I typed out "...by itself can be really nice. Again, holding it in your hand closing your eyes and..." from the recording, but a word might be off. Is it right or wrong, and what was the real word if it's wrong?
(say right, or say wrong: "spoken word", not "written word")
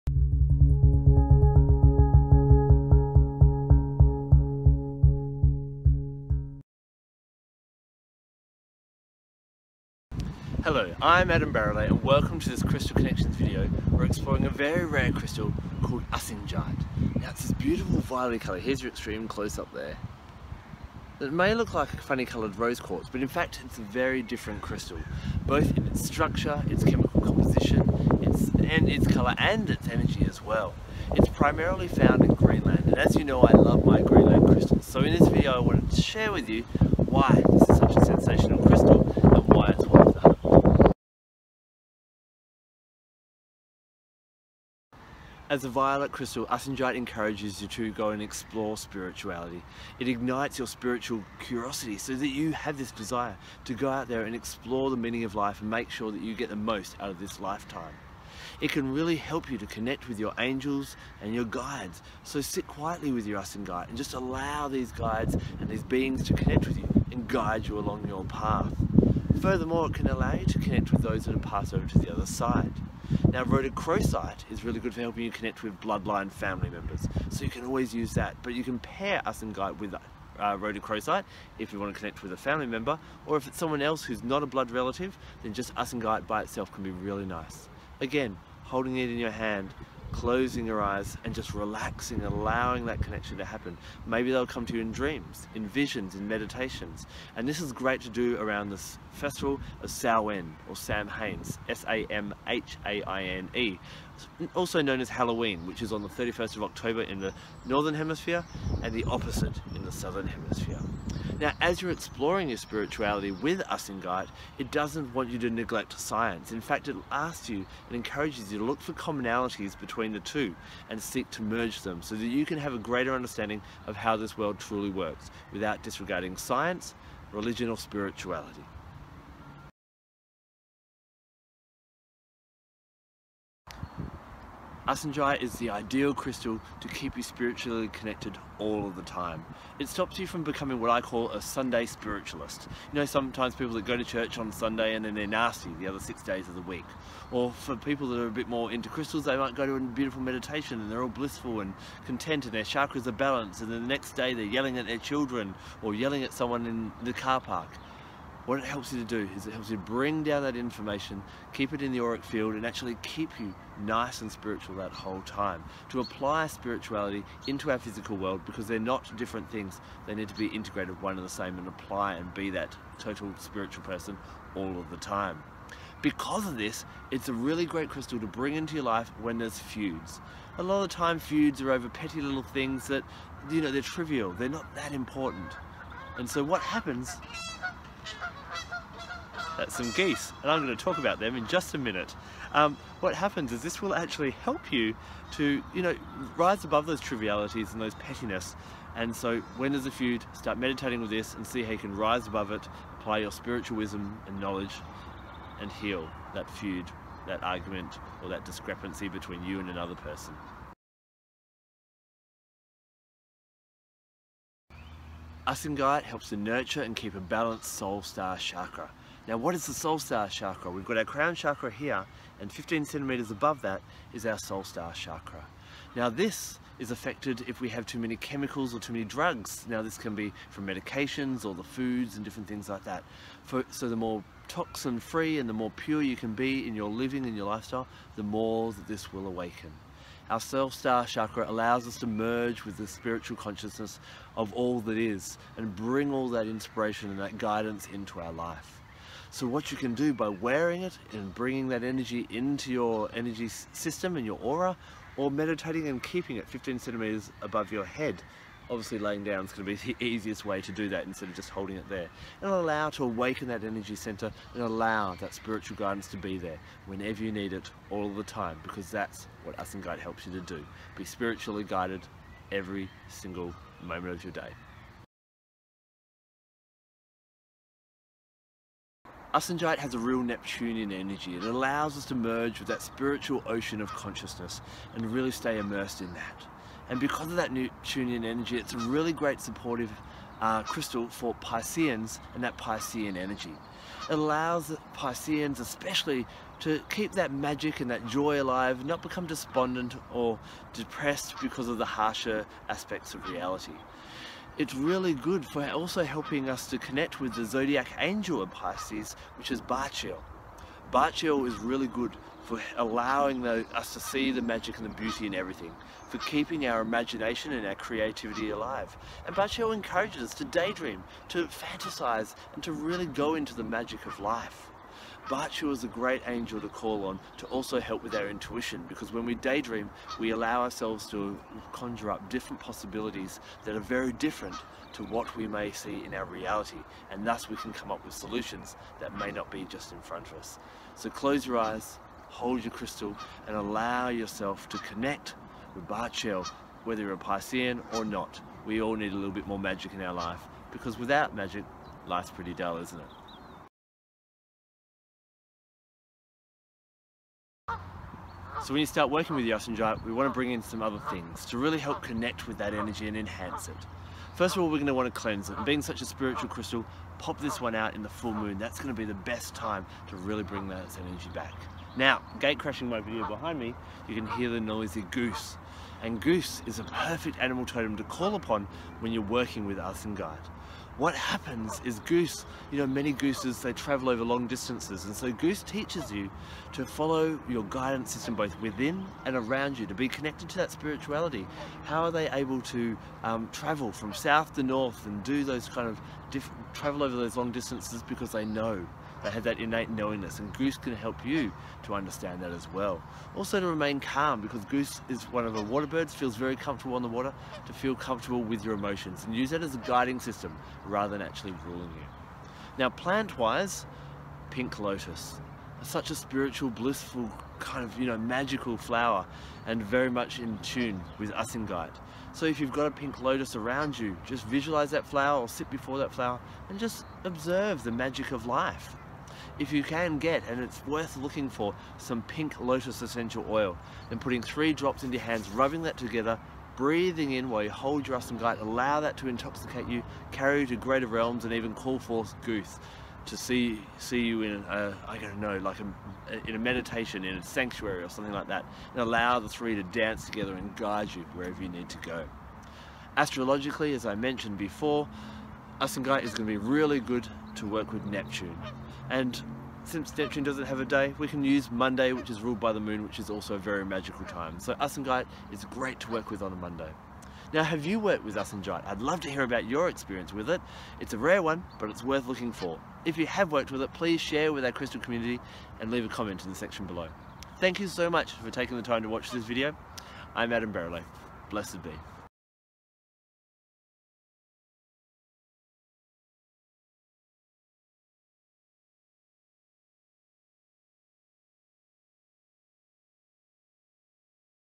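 right.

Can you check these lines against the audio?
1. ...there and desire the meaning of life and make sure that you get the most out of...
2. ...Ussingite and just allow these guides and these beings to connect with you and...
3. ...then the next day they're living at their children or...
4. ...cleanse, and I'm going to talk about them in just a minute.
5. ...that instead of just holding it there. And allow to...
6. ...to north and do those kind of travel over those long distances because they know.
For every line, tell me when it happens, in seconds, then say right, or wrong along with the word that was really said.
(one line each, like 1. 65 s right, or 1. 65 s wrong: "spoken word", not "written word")
1. 54 s wrong: "explore", not "desire"
2. 63 s right
3. 153 s wrong: "yelling", not "living"
4. 189 s wrong: "geese", not "cleanse"
5. 260 s right
6. 394 s right.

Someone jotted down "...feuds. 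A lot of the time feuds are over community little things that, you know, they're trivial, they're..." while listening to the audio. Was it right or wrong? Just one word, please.
wrong.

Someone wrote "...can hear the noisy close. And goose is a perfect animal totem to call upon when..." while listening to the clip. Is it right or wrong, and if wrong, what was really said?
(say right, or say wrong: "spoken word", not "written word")
wrong: "goose", not "close".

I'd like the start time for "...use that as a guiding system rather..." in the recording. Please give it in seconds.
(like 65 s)
409 s.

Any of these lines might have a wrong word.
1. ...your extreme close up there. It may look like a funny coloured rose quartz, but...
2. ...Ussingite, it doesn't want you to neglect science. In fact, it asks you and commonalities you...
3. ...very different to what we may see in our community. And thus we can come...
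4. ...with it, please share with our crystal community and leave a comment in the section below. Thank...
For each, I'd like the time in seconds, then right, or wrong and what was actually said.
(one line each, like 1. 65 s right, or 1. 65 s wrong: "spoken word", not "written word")
1. 18 s right
2. 113 s wrong: "encourages", not "commonalities"
3. 333 s wrong: "reality", not "community"
4. 473 s right.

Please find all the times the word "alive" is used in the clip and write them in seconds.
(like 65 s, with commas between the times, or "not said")
298 s, 318 s.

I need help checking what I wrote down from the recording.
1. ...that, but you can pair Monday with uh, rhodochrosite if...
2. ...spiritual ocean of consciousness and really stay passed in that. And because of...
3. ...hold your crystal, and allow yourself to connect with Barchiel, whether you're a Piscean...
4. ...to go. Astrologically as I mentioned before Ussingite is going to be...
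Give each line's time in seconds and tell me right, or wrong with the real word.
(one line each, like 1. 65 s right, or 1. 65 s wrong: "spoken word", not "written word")
1. 78 s wrong: "Ussingite", not "Monday"
2. 282 s wrong: "immersed", not "passed"
3. 342 s right
4. 451 s right.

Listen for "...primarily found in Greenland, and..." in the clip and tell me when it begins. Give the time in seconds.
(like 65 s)
31 s.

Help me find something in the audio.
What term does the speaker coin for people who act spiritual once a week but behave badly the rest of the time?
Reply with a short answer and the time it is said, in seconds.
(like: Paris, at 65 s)
Sunday spiritualist, at 141 s.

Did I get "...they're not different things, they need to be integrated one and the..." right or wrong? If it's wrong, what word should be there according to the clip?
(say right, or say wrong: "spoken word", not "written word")
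right.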